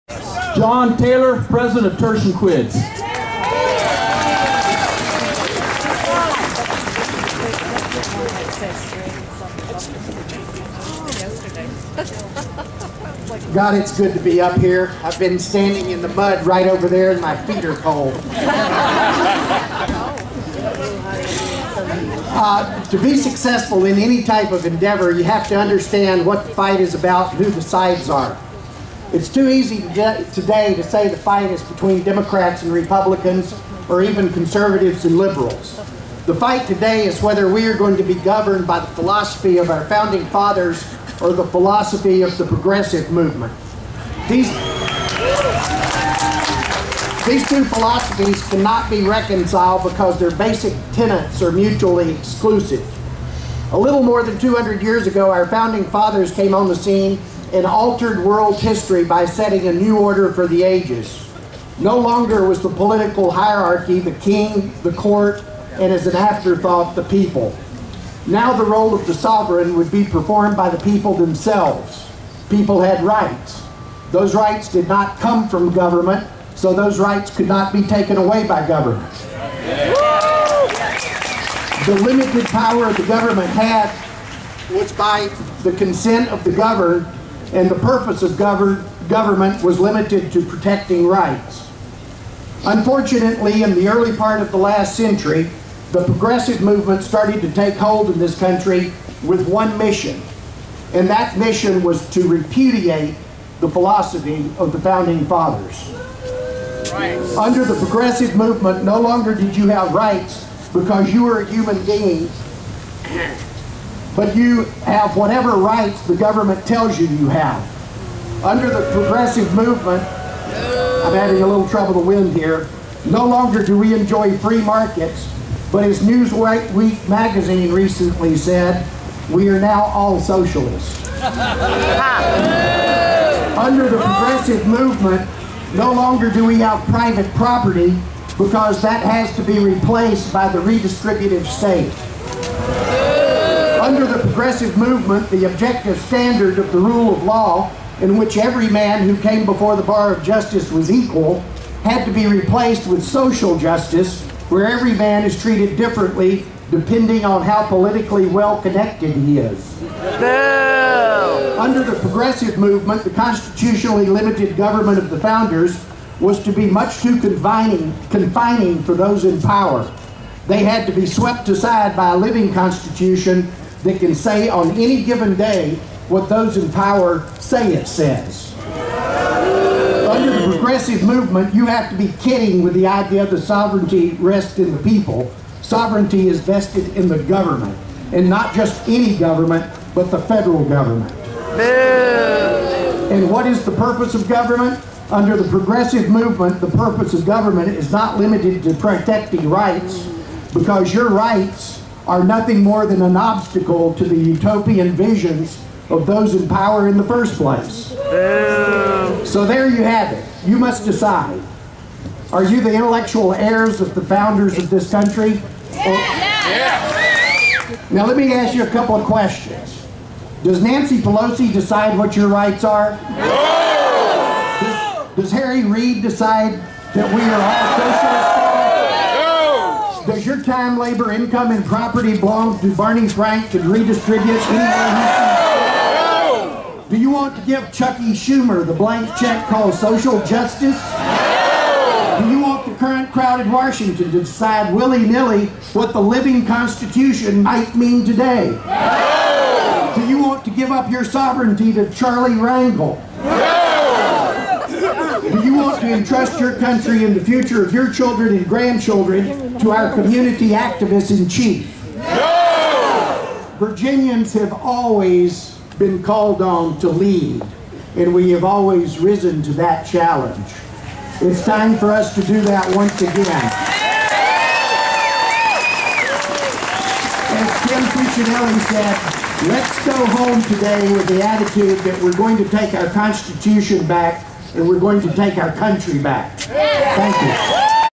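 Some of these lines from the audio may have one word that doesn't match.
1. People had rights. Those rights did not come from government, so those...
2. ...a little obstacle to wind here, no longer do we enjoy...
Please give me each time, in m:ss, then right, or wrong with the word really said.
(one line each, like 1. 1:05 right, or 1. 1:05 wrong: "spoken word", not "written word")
1. 1:12 right
2. 2:01 wrong: "trouble", not "obstacle".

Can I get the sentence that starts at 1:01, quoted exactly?
No longer was the political hierarchy the king, the court, and as an afterthought, the people.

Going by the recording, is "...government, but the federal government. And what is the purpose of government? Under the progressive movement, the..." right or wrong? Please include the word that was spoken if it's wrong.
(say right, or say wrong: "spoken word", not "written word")
right.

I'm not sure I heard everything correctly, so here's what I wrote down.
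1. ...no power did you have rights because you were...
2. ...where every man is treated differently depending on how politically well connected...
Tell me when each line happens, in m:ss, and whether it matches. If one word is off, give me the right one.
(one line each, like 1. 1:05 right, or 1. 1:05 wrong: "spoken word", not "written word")
1. 1:48 wrong: "longer", not "power"
2. 2:34 right.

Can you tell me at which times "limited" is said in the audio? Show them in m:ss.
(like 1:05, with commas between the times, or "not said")
1:22, 1:29, 2:44, 3:18.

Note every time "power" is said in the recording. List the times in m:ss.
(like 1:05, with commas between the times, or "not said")
1:22, 2:49, 2:56, 3:26.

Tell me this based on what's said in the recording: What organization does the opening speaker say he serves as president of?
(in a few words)
Tertium Quids.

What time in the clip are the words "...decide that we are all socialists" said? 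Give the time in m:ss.
3:46.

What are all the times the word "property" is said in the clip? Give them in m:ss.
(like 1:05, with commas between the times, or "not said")
2:17, 3:51.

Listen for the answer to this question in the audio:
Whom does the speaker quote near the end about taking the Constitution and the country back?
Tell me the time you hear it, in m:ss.
4:37.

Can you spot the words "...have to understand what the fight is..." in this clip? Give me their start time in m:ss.
0:25.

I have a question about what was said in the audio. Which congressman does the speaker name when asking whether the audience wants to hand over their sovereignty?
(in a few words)
Charlie Rangel.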